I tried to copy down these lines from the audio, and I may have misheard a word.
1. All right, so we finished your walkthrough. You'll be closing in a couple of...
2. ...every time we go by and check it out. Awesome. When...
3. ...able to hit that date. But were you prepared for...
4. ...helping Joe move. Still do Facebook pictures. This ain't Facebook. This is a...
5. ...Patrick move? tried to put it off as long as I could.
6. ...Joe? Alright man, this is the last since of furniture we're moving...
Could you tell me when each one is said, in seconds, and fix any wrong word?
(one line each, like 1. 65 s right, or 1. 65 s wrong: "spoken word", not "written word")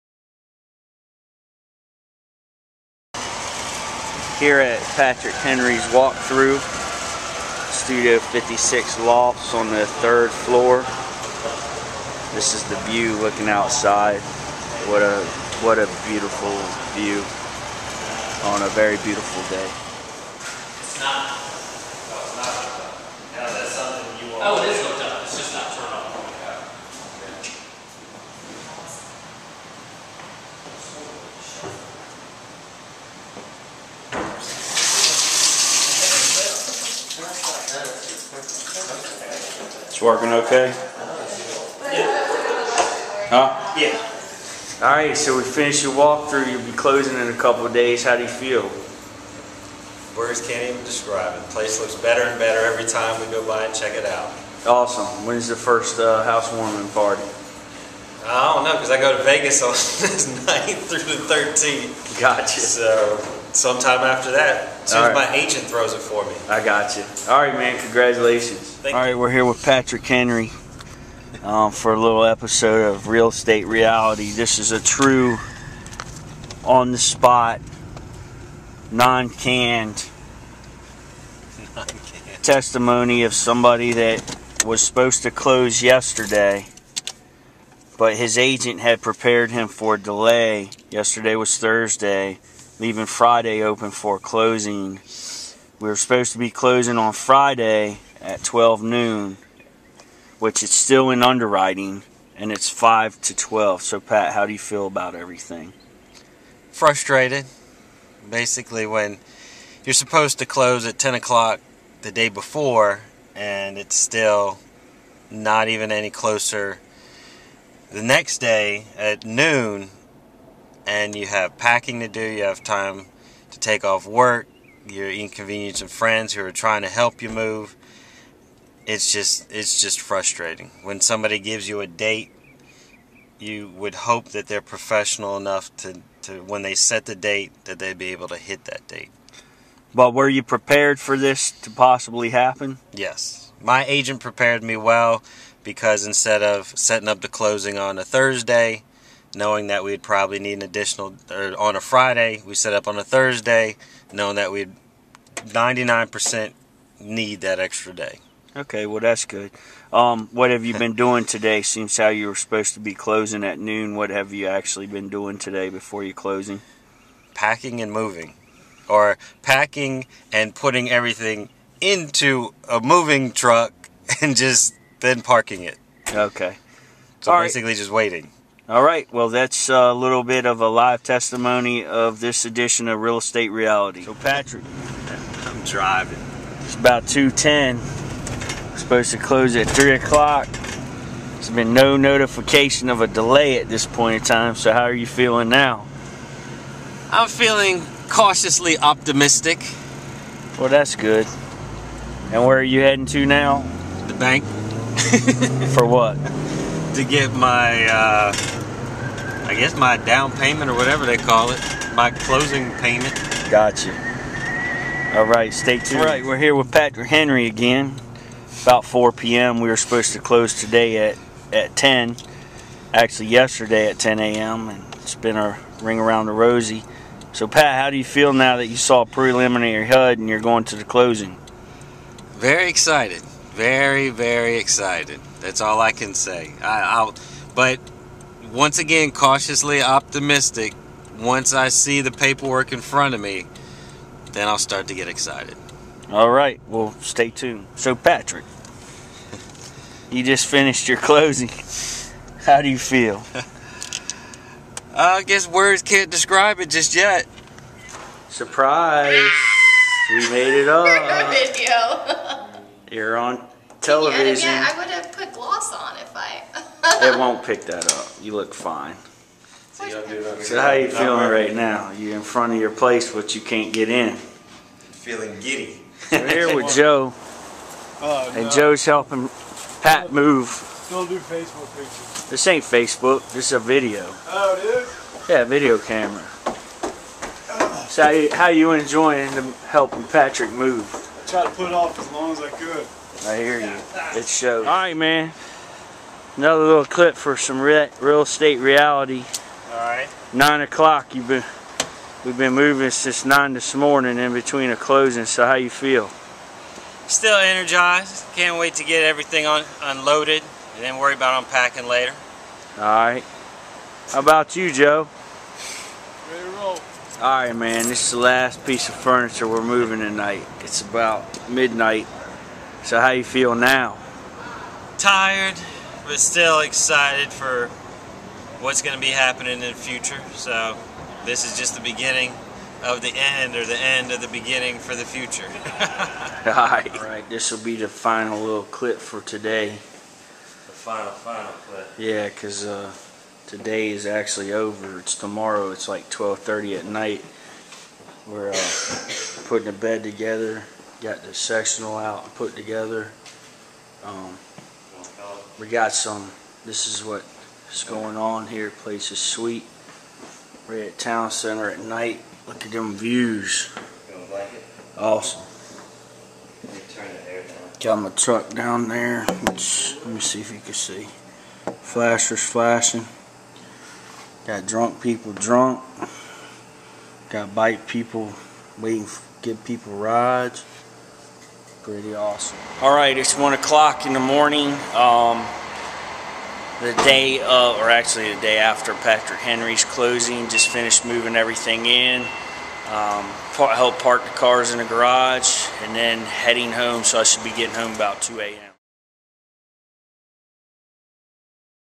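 1. 44 s right
2. 52 s right
3. 138 s right
4. 278 s wrong: "Pat", not "Joe"
5. 290 s right
6. 314 s wrong: "piece", not "since".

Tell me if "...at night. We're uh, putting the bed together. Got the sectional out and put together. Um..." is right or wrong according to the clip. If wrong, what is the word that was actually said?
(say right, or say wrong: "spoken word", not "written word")
right.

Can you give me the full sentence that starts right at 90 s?
Yesterday was Thursday, leaving Friday open for closing.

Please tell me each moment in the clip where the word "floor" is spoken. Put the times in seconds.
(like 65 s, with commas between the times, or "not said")
10 s.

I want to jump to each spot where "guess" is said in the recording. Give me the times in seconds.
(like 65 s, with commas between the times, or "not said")
209 s, 255 s.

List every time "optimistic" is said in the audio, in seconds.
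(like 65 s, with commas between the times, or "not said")
198 s, 239 s.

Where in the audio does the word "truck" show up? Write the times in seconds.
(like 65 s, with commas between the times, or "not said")
173 s, 368 s.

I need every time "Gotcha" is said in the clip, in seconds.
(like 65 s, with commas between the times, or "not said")
62 s, 213 s.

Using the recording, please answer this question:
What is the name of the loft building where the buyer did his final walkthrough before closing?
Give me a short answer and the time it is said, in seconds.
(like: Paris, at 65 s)
Studio 56 Lofts, at 7 s.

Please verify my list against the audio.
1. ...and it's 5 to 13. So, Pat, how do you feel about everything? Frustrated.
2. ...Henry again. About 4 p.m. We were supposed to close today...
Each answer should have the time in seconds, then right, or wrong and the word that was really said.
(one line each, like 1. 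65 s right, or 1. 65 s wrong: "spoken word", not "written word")
1. 102 s wrong: "12", not "13"
2. 217 s right.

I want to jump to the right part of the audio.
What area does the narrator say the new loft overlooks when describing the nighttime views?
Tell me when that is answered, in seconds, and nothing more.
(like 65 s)
360 s.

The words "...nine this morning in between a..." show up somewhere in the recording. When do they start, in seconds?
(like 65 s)
303 s.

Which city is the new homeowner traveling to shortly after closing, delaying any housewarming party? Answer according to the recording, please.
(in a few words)
Vegas.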